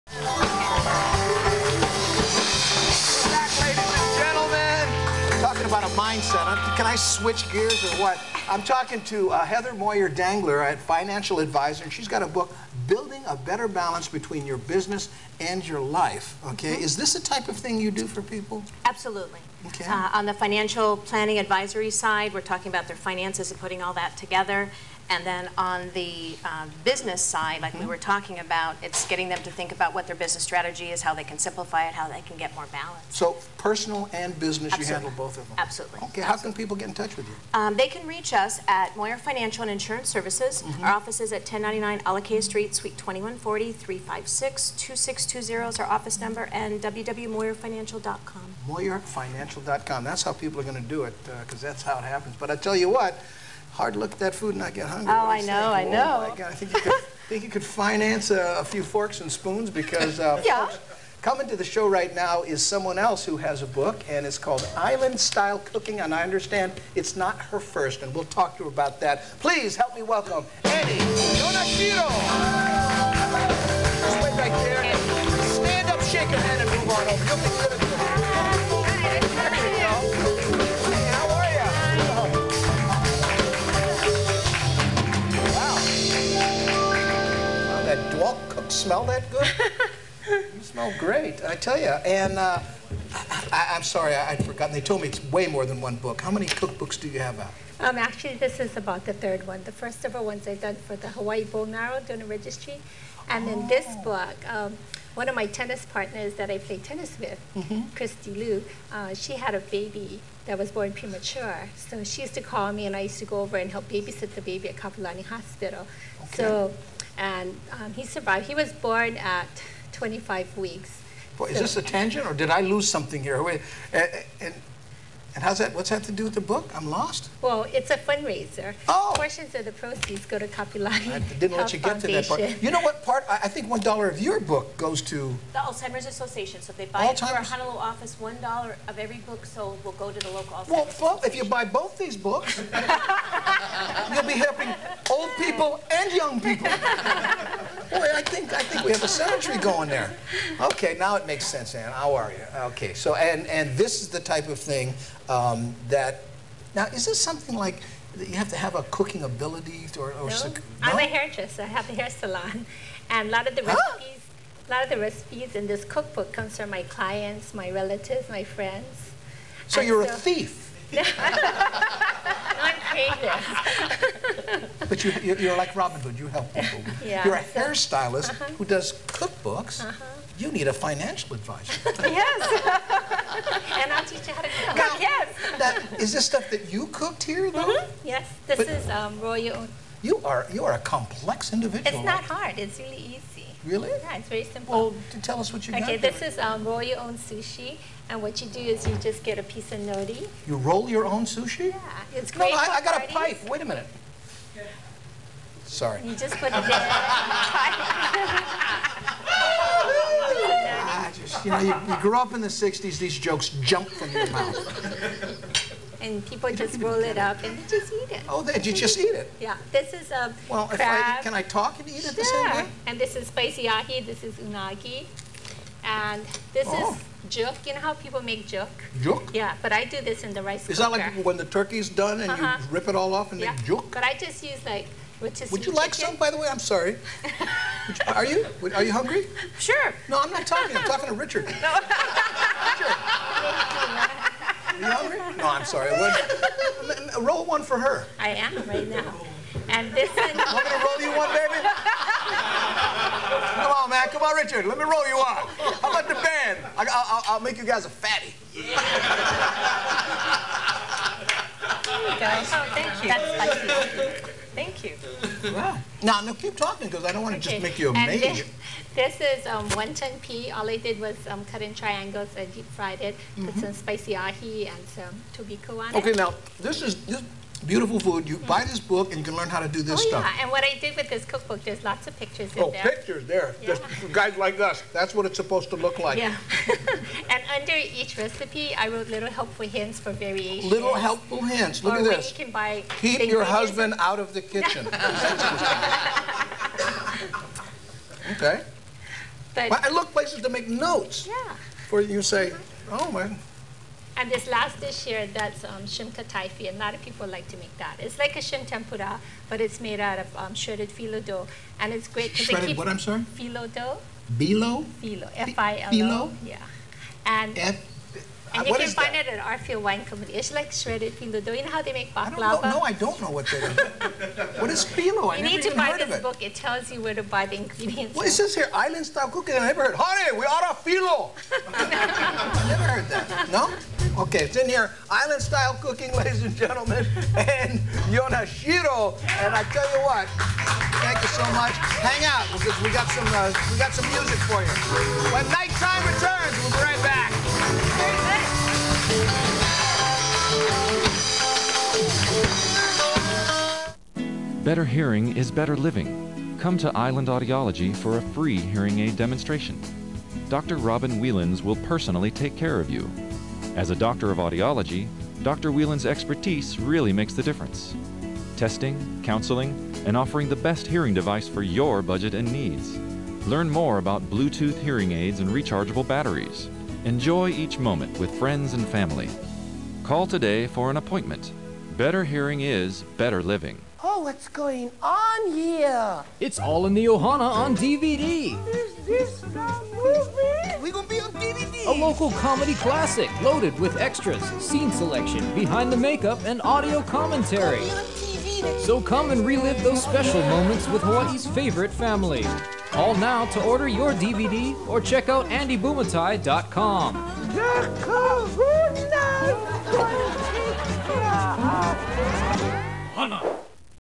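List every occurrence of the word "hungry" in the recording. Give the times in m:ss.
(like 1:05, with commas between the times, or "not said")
0:54, 3:58, 4:05.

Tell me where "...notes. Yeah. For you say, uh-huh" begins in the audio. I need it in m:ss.
5:00.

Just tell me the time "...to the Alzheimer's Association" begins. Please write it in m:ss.
2:15.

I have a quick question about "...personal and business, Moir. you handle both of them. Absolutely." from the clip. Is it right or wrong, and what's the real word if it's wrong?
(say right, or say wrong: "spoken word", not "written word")
wrong: "Absolutely", not "Moir".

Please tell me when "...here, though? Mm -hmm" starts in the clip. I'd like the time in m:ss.
3:07.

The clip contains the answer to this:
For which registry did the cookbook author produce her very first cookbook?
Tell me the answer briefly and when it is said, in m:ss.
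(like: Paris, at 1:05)
Hawaii Bone Marrow Donor Registry, at 1:41.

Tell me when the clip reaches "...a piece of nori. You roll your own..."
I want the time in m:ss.
3:19.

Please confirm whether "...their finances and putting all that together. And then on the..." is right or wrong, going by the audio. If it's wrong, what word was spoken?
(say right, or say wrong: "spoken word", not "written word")
right.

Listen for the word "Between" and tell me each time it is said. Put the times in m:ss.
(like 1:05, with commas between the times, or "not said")
0:14.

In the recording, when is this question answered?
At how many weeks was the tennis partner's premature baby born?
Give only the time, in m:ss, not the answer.
1:59.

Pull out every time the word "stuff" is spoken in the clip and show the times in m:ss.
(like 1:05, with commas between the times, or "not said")
3:06, 4:40.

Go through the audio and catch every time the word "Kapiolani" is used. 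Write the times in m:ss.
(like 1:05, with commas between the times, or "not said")
1:54, 2:10.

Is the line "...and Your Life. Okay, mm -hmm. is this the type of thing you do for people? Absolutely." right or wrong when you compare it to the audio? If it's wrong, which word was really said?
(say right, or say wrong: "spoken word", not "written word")
right.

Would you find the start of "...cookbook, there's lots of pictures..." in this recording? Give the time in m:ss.
4:41.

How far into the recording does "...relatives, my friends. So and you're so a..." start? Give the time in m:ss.
2:47.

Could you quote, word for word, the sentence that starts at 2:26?
Boy, I think I think we have a century going there.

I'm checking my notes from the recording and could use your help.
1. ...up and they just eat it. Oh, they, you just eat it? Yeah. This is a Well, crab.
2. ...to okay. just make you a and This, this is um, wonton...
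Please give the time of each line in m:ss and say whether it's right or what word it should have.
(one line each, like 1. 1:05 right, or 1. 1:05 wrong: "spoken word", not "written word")
1. 3:37 right
2. 4:27 right.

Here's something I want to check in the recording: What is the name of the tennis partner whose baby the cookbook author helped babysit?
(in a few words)
Christy Liu.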